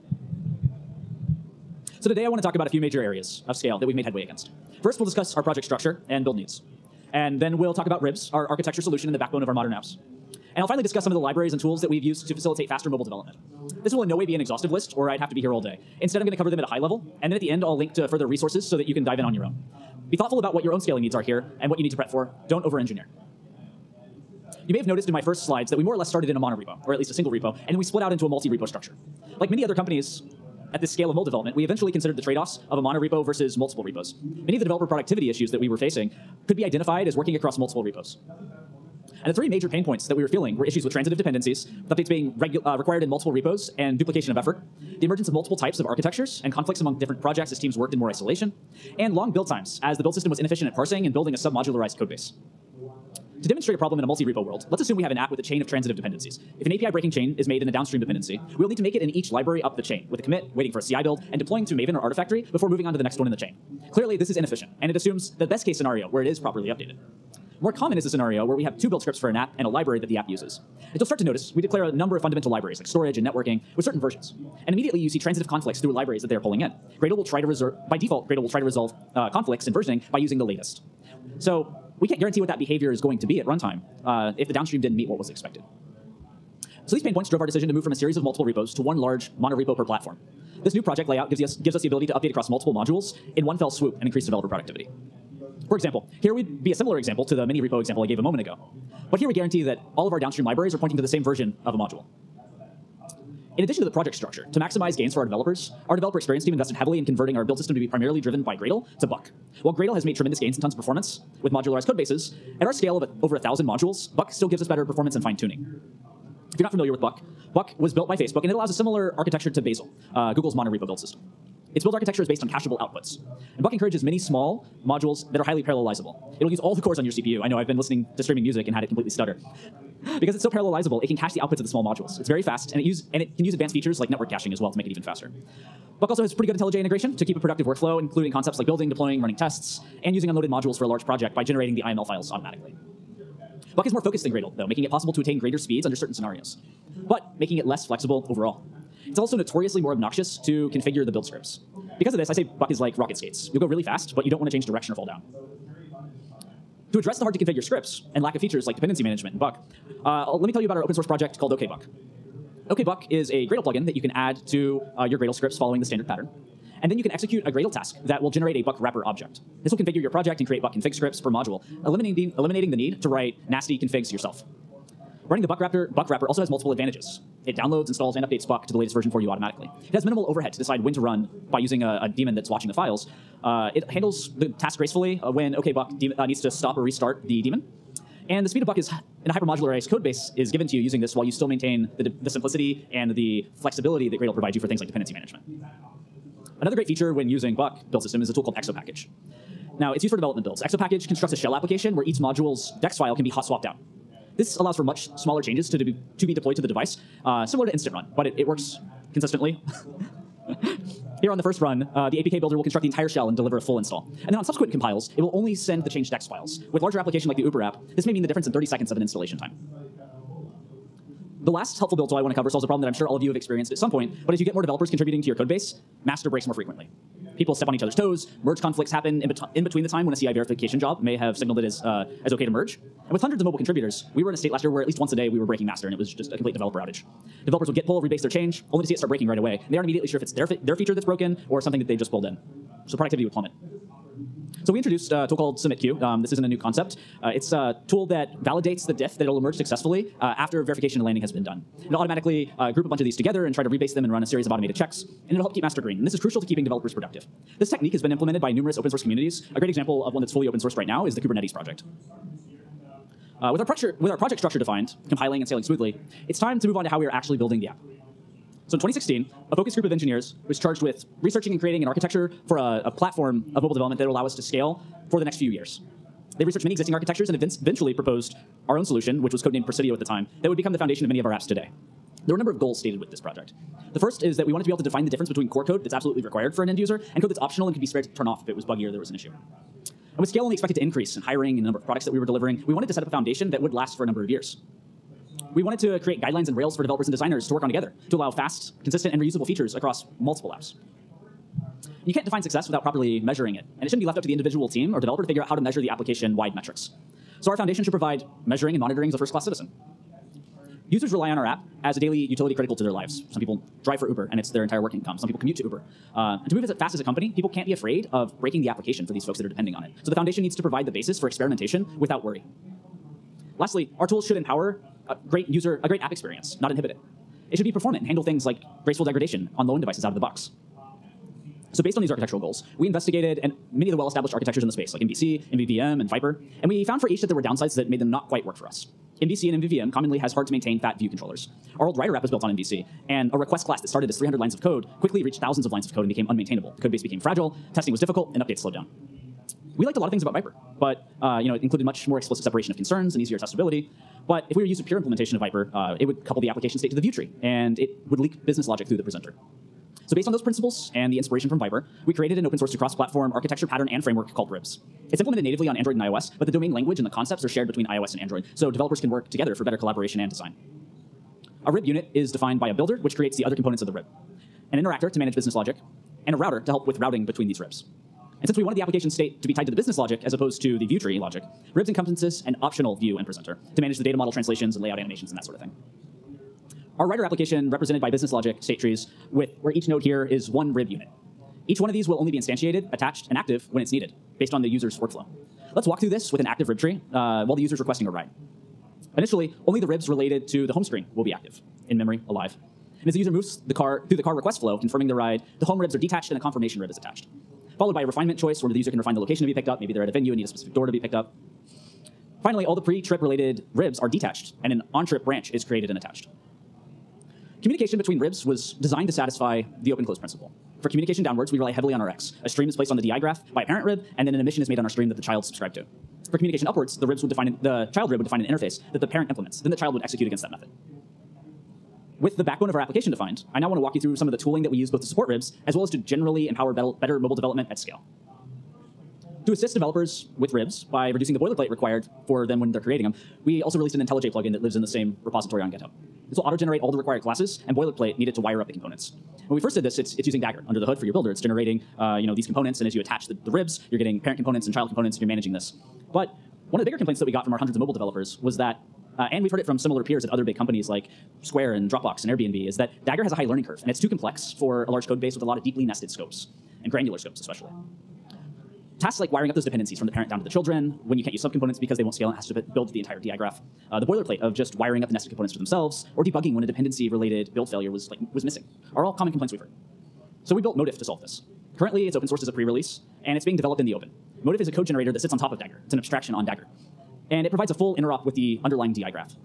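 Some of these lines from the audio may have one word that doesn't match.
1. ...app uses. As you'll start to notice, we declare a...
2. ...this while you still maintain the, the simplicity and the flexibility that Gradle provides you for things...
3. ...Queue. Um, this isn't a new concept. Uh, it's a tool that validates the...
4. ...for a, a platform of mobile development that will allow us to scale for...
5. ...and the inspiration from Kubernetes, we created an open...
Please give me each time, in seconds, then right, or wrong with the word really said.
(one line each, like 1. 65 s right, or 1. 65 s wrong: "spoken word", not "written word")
1. 70 s right
2. 190 s right
3. 245 s right
4. 272 s right
5. 360 s wrong: "Viper", not "Kubernetes".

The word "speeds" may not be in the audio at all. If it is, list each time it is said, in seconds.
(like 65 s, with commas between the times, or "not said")
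145 s, 188 s.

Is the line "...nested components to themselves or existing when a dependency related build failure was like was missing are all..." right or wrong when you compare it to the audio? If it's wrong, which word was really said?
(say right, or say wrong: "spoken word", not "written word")
wrong: "debugging", not "existing".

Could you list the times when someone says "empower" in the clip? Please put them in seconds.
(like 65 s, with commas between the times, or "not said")
324 s, 436 s.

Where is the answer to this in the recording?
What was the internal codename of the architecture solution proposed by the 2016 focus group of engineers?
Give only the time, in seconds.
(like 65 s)
279 s.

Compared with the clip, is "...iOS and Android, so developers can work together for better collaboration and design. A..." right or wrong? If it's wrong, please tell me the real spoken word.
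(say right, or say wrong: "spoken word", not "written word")
right.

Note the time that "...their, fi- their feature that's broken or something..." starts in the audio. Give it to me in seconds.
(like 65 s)
240 s.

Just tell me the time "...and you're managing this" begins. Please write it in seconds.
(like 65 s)
455 s.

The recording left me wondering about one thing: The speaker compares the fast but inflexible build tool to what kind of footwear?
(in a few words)
rocket skates.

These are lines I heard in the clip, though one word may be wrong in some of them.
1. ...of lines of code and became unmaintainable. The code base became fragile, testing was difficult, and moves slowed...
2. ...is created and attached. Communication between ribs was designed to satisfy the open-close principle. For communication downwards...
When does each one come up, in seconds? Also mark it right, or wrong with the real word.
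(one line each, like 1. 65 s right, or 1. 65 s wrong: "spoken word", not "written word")
1. 345 s wrong: "updates", not "moves"
2. 415 s right.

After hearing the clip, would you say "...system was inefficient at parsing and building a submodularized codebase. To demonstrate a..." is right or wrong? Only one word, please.
right.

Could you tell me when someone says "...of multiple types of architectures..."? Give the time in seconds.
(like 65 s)
45 s.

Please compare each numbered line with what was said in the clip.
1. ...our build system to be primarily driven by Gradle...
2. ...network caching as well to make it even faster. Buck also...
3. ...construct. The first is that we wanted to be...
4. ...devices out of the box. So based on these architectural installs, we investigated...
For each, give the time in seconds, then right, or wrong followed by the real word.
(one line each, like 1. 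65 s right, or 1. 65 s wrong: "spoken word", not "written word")
1. 107 s right
2. 134 s right
3. 283 s wrong: "project", not "construct"
4. 329 s wrong: "goals", not "installs".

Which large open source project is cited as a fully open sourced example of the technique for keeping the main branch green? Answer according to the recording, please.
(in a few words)
Kubernetes.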